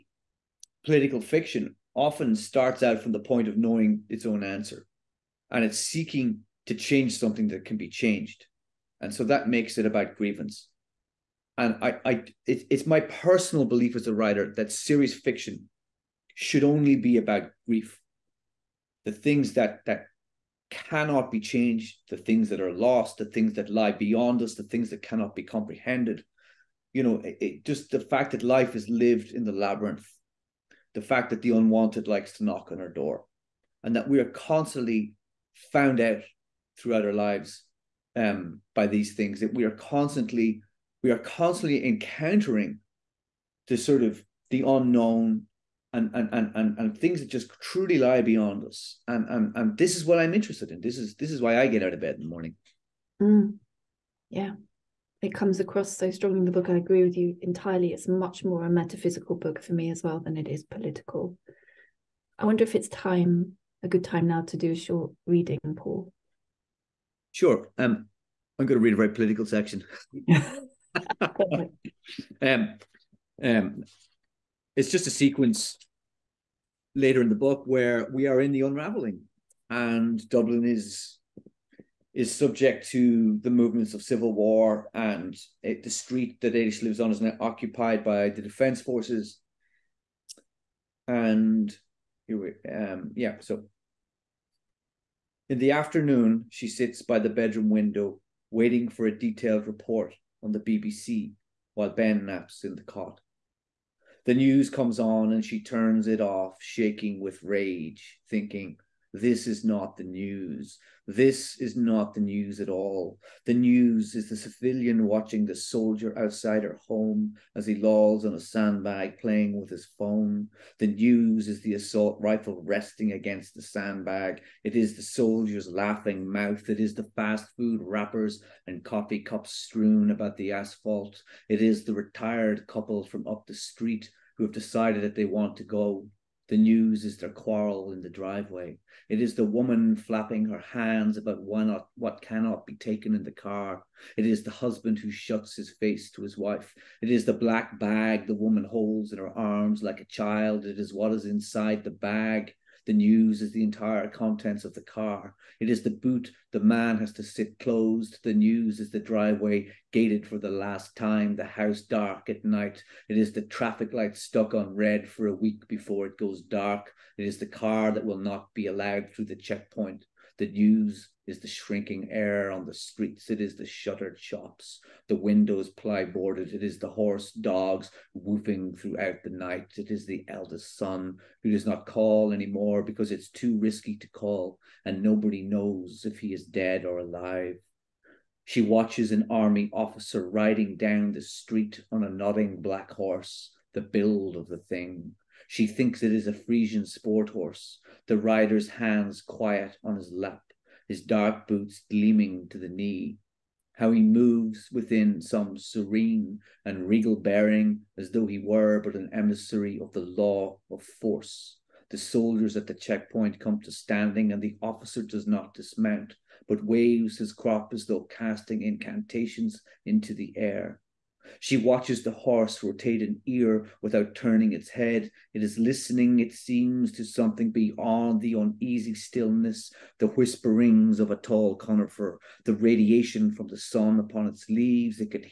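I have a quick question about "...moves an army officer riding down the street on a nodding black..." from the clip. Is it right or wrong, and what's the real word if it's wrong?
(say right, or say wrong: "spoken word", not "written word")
wrong: "watches", not "moves".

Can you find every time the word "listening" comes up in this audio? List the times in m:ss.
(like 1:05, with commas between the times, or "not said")
3:45.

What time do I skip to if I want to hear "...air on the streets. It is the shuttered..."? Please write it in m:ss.
2:52.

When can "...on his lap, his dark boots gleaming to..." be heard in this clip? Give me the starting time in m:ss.
3:19.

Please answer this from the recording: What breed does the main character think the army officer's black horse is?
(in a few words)
Frisian sport horse.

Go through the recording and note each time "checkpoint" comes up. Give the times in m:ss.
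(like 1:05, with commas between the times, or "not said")
2:49, 3:32.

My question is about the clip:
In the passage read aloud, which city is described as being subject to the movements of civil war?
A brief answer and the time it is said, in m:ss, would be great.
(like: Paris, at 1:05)
Dublin, at 1:20.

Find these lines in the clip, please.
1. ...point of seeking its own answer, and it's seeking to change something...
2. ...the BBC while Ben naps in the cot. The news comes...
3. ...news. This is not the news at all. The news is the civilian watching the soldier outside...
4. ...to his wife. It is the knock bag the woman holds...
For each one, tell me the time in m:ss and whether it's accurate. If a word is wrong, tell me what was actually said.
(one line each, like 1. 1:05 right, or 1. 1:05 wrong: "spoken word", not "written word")
1. 0:03 wrong: "knowing", not "seeking"
2. 1:40 right
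3. 1:50 right
4. 2:26 wrong: "black", not "knock".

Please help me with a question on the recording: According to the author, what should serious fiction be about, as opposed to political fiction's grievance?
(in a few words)
grief.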